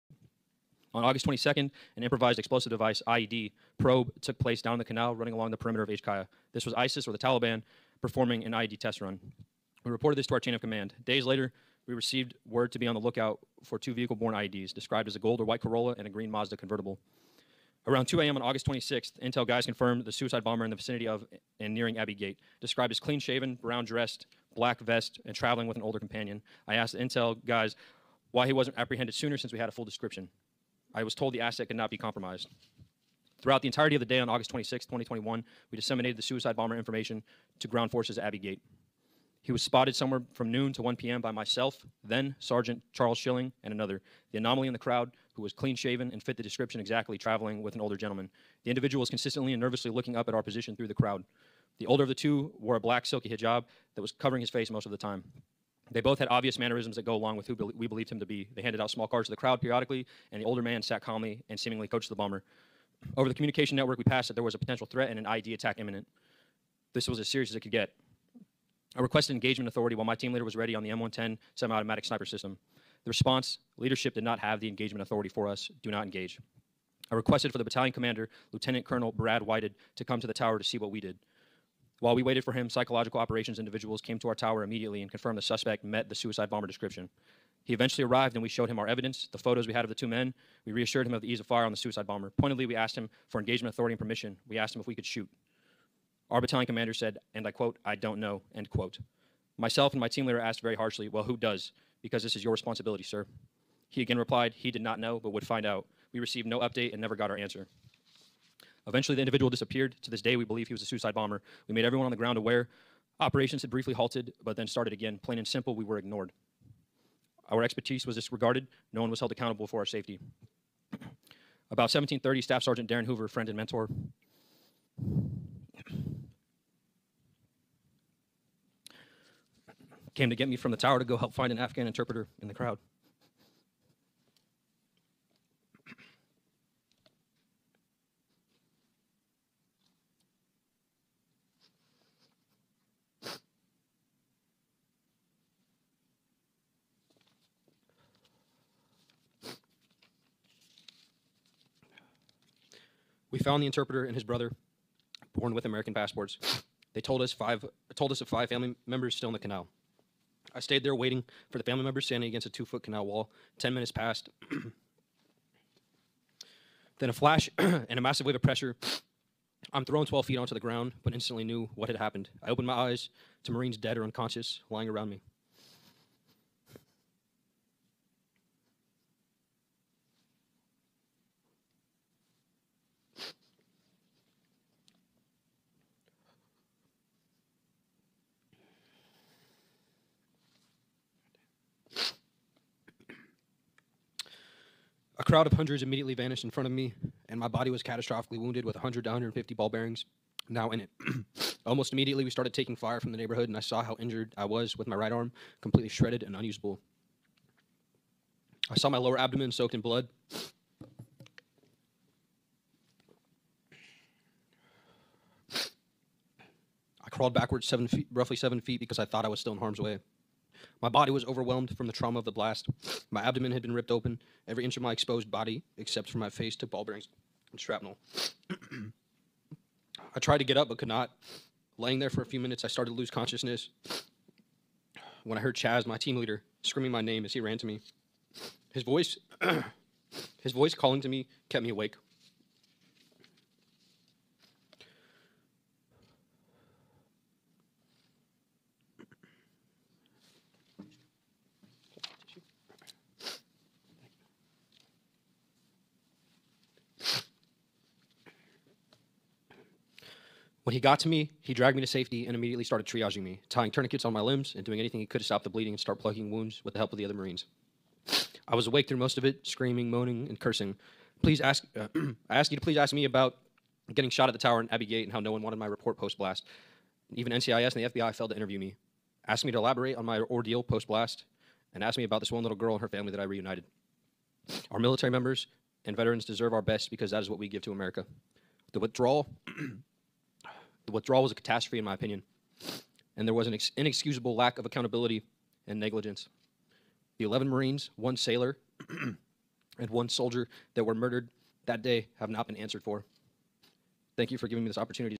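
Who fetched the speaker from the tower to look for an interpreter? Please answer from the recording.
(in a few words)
Darin Hoover.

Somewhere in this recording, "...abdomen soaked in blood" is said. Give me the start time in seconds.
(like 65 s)
209 s.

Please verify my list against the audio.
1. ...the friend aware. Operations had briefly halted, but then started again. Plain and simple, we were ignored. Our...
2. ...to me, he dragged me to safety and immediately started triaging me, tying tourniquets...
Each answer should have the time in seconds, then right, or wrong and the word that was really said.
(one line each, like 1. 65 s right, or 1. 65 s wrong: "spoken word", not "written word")
1. 112 s wrong: "ground", not "friend"
2. 260 s right.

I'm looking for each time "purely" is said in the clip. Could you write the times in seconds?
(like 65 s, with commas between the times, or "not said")
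not said.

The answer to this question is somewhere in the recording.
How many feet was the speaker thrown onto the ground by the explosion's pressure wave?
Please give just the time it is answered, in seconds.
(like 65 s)
170 s.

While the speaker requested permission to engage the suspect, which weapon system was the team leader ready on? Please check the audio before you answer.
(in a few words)
M110.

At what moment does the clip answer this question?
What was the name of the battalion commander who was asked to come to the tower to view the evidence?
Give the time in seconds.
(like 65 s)
79 s.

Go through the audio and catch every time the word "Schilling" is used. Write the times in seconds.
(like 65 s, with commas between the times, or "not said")
43 s.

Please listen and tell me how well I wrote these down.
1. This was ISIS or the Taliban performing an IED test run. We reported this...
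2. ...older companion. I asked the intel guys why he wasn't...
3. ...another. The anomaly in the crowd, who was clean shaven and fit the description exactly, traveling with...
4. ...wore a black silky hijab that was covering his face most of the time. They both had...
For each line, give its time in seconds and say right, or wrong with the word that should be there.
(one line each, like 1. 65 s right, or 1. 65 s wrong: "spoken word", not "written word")
1. 6 s right
2. 25 s right
3. 43 s right
4. 52 s right.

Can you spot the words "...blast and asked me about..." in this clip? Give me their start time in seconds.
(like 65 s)
280 s.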